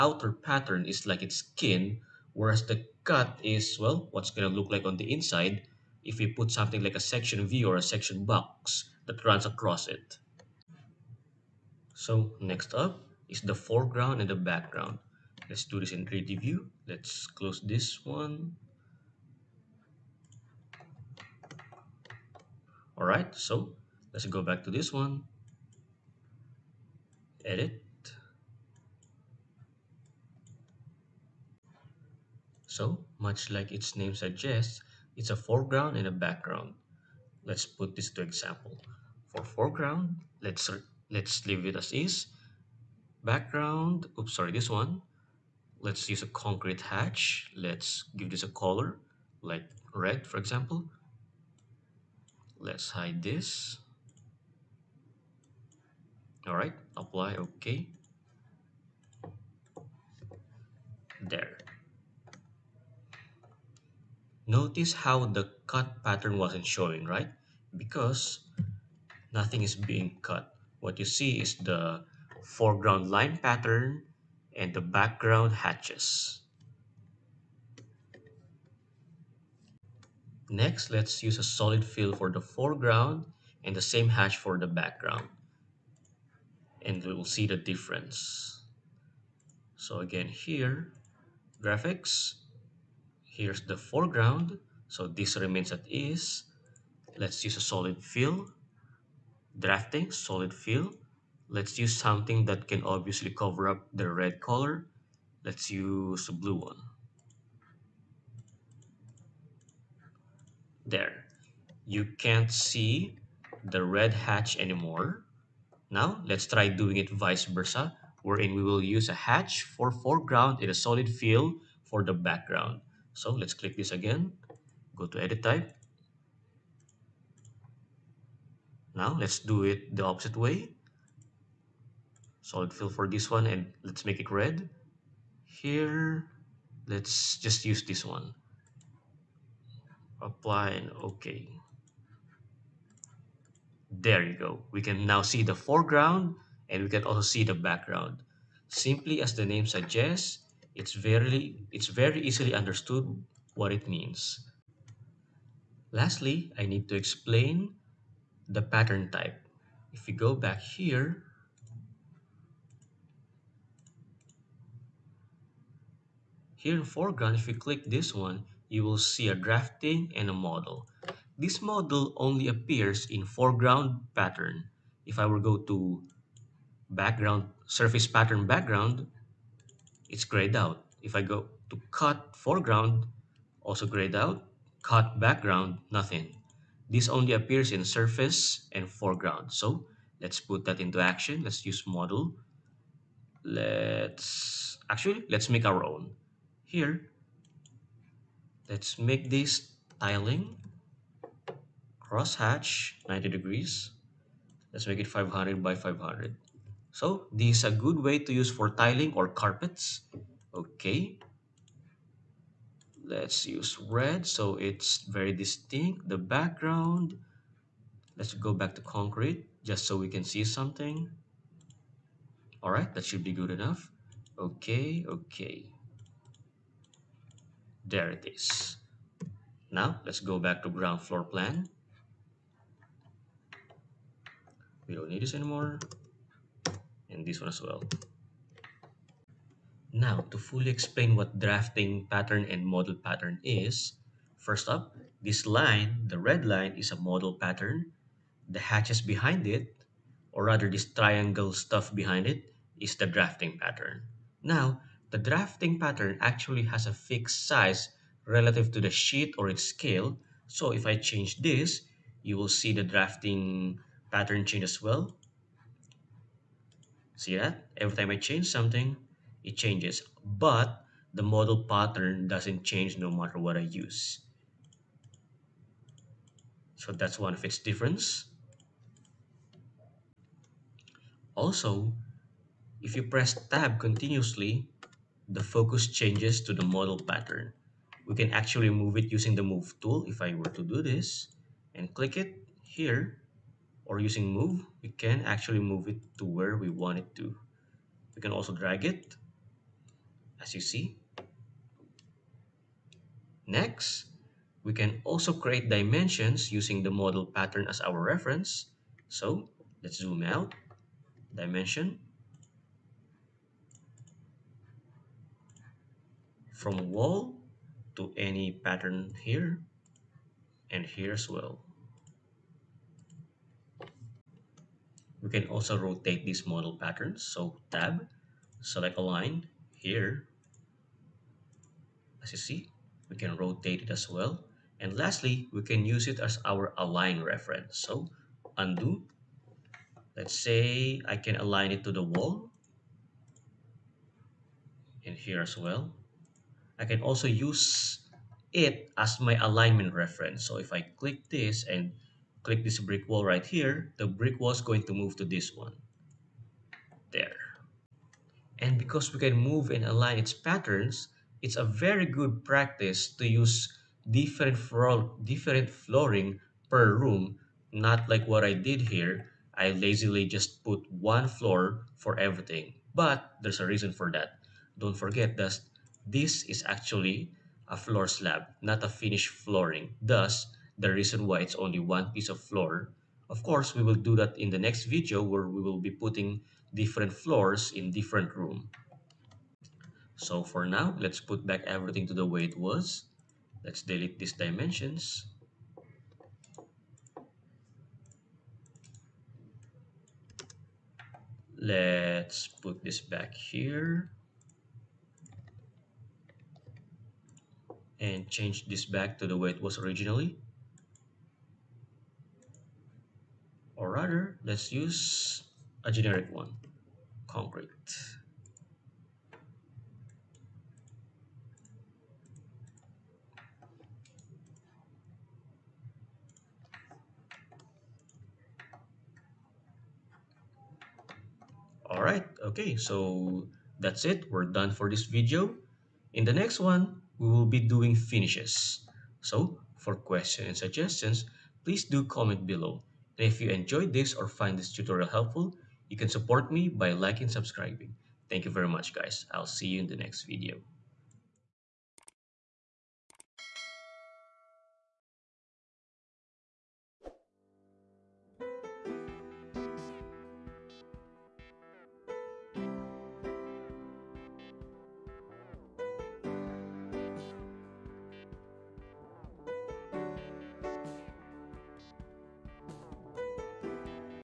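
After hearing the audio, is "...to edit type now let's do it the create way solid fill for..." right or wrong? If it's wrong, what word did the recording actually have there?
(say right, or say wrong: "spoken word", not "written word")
wrong: "opposite", not "create".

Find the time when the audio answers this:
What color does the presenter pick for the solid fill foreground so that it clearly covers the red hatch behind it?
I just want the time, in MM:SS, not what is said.
01:46.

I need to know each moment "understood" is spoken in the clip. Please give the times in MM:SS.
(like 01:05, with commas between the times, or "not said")
02:32.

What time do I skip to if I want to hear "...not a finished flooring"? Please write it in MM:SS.
06:18.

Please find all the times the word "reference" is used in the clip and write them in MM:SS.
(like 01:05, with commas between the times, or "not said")
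05:08, 05:37, 05:49.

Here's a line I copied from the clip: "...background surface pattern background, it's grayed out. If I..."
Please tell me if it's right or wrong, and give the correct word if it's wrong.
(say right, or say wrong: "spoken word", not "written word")
right.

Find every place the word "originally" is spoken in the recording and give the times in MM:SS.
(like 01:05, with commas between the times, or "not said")
06:49.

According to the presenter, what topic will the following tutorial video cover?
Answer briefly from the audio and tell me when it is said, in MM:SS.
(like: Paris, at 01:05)
Finishes, at 07:17.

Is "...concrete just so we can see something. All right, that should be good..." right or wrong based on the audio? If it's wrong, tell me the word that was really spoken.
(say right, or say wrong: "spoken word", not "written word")
right.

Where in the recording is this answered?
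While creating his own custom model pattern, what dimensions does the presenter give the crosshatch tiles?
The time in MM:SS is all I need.
03:25.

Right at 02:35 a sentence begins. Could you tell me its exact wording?
Lastly, I need to explain the pattern type.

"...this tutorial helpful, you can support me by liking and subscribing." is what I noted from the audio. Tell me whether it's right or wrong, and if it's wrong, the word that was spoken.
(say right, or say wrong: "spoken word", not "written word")
right.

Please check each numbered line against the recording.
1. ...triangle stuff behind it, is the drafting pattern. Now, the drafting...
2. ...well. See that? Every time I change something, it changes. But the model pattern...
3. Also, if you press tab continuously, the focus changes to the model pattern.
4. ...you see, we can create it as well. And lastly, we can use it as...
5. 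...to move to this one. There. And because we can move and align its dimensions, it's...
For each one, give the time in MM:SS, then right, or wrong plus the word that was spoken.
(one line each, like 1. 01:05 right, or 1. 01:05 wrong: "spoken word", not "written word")
1. 04:10 right
2. 04:24 right
3. 04:41 right
4. 05:32 wrong: "rotate", not "create"
5. 05:54 wrong: "patterns", not "dimensions".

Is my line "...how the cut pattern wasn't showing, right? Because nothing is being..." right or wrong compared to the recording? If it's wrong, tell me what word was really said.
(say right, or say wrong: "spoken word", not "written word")
right.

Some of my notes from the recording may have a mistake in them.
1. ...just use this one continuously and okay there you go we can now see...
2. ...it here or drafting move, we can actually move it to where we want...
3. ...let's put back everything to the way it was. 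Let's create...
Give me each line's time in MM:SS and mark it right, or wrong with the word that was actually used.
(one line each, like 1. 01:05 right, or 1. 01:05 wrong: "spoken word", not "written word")
1. 02:17 wrong: "apply", not "continuously"
2. 04:52 wrong: "using", not "drafting"
3. 06:30 wrong: "delete", not "create".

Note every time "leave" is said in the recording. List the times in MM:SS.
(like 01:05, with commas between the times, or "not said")
00:41.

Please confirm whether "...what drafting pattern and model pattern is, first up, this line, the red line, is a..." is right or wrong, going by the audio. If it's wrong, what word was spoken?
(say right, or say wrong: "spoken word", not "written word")
right.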